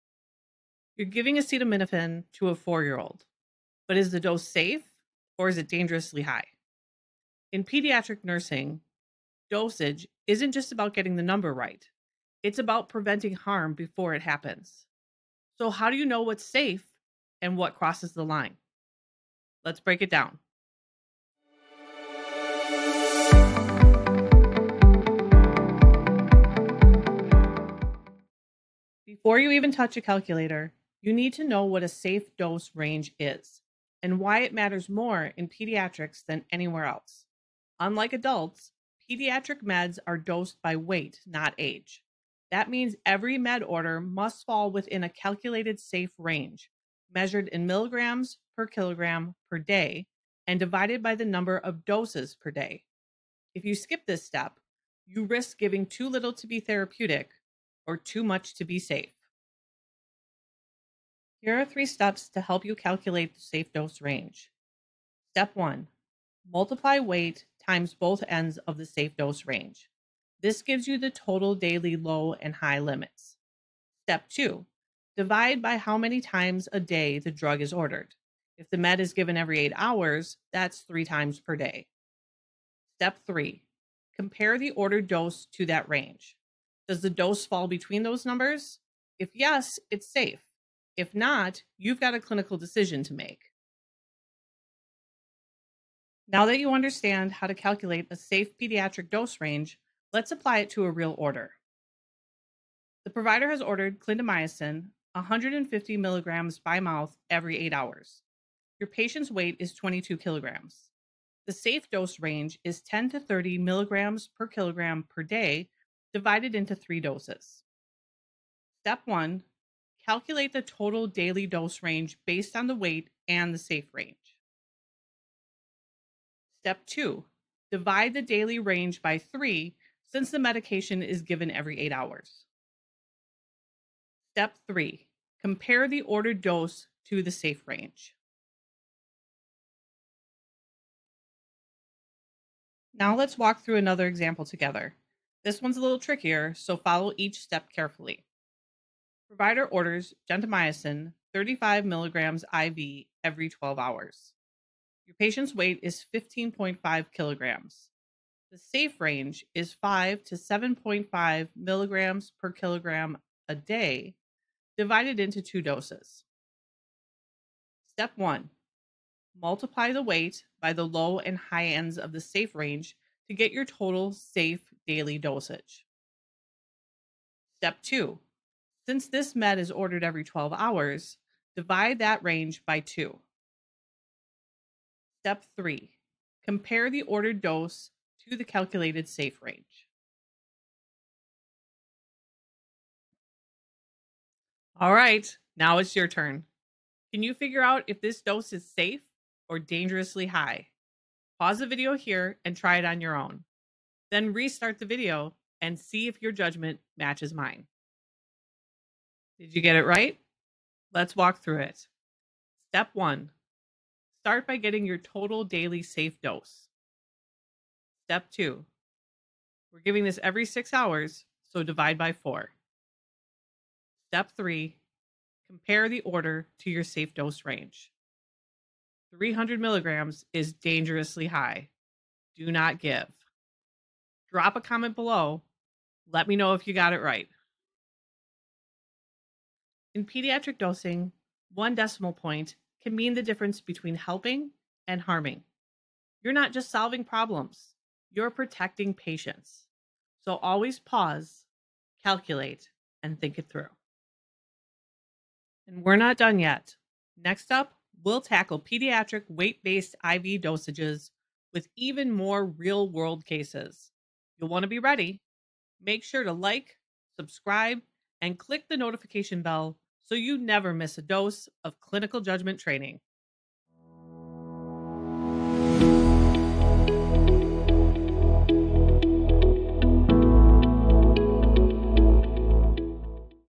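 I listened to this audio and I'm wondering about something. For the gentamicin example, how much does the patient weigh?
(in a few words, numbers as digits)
15.5 kilograms.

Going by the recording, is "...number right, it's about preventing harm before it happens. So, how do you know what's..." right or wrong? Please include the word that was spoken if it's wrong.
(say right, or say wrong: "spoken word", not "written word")
right.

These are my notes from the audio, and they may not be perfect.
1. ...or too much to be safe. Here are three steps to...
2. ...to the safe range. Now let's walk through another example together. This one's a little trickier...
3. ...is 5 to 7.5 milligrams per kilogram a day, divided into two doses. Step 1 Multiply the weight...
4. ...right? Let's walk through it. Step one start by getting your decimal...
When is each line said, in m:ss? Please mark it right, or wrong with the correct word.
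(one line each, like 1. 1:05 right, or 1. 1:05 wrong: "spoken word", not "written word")
1. 0:57 right
2. 2:17 right
3. 2:39 right
4. 3:29 wrong: "total", not "decimal".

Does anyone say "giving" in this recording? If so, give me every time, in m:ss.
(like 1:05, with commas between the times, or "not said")
0:01, 0:55, 3:39.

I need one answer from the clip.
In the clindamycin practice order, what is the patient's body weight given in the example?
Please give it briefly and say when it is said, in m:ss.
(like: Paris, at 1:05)
22 kilograms, at 1:49.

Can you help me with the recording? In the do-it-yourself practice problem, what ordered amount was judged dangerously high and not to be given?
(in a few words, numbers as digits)
300 milligrams.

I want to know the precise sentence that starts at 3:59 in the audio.
In pediatric dosing, one decimal point can mean the difference between helping and harming.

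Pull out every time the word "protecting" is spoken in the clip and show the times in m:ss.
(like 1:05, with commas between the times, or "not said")
4:08.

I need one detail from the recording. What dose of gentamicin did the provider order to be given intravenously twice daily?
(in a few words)
35 milligrams.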